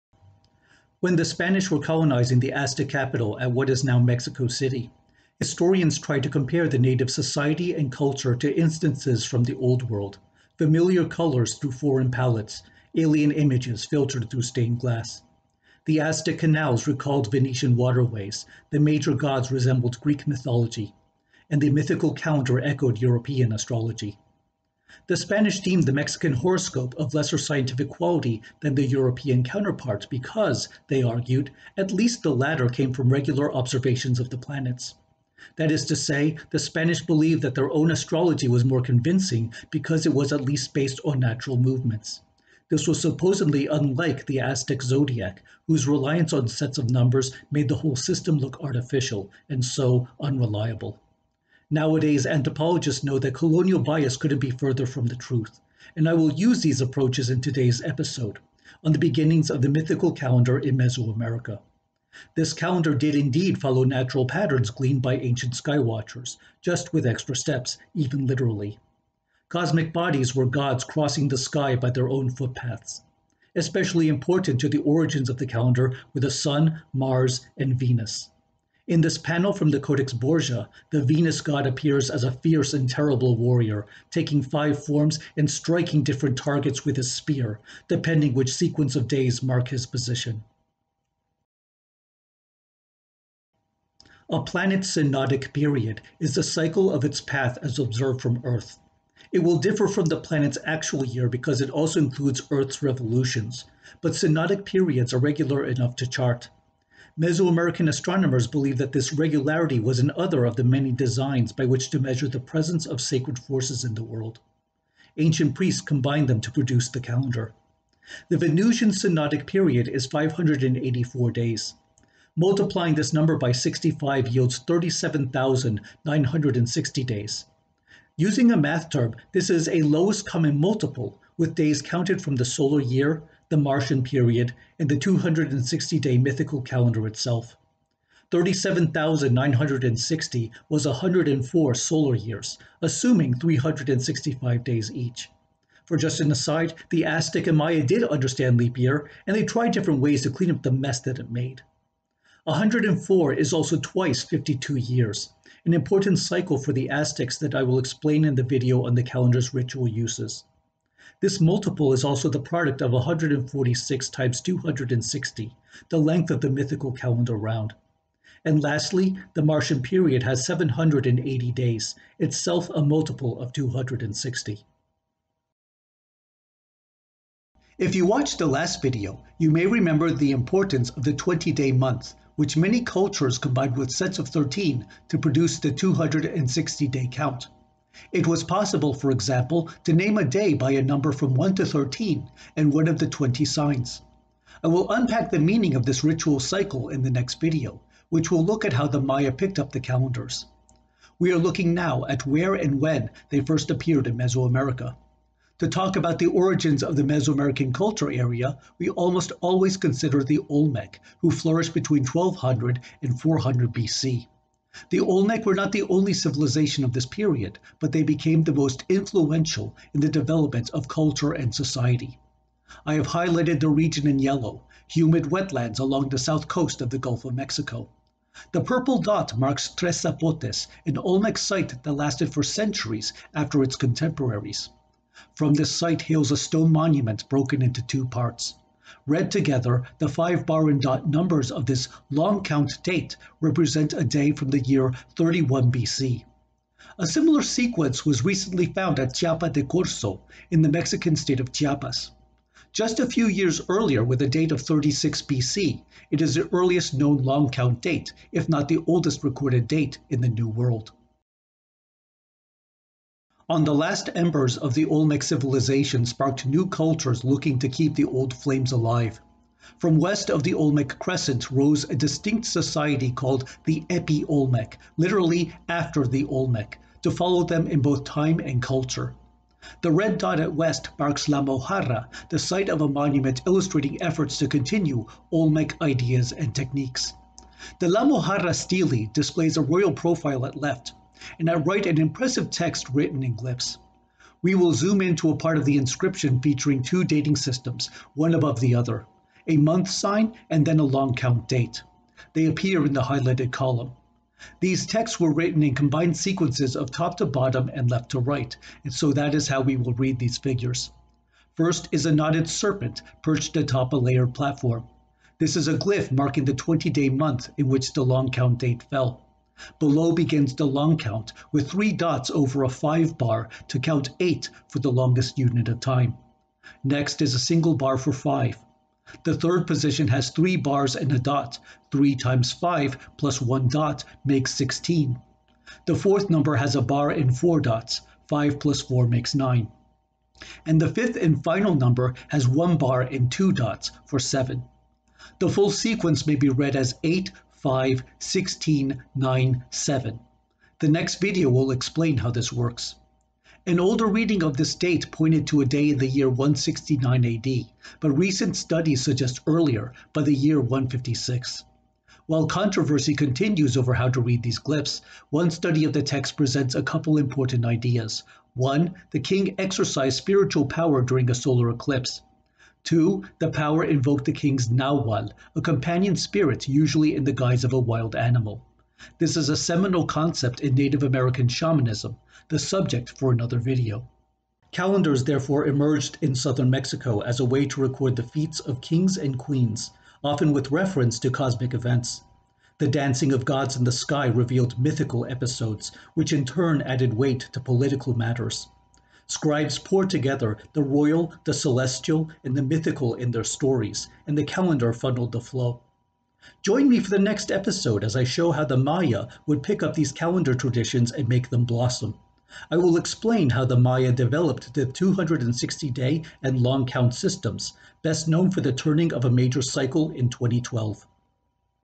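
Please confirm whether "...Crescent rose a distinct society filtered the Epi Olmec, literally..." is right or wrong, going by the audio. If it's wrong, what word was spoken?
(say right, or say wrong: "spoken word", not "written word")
wrong: "called", not "filtered".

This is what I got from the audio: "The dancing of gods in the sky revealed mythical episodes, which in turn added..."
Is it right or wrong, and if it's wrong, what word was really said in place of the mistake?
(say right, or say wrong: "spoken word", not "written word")
right.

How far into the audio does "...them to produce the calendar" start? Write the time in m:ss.
1:56.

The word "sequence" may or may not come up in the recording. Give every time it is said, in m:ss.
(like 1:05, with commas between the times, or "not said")
1:28, 4:07, 5:06, 5:45.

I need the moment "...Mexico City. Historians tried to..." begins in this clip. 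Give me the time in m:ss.
0:03.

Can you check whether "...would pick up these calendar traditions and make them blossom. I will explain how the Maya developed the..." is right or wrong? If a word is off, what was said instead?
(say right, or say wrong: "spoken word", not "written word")
right.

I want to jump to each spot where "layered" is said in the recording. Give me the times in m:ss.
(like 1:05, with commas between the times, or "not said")
5:13.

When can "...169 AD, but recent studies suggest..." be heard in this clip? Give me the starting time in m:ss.
5:56.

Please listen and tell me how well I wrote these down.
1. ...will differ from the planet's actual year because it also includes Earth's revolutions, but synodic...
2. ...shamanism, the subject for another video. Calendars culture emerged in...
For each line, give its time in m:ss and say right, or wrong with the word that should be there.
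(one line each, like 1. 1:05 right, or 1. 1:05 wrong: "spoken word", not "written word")
1. 1:39 right
2. 6:21 wrong: "therefore", not "culture".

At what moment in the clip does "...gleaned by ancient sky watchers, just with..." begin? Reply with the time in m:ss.
1:04.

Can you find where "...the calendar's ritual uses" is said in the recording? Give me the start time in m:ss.
2:38.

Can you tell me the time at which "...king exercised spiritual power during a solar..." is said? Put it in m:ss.
6:09.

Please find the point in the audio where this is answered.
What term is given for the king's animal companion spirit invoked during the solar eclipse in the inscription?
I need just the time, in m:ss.
6:14.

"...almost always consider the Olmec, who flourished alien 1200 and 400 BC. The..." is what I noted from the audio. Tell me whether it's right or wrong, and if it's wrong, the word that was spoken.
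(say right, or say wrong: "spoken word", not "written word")
wrong: "between", not "alien".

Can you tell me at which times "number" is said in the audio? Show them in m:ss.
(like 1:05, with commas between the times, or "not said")
0:46, 2:03, 3:10, 4:01, 5:36, 5:41.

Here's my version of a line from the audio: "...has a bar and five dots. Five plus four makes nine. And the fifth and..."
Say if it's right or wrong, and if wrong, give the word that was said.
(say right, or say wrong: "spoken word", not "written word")
wrong: "four", not "five".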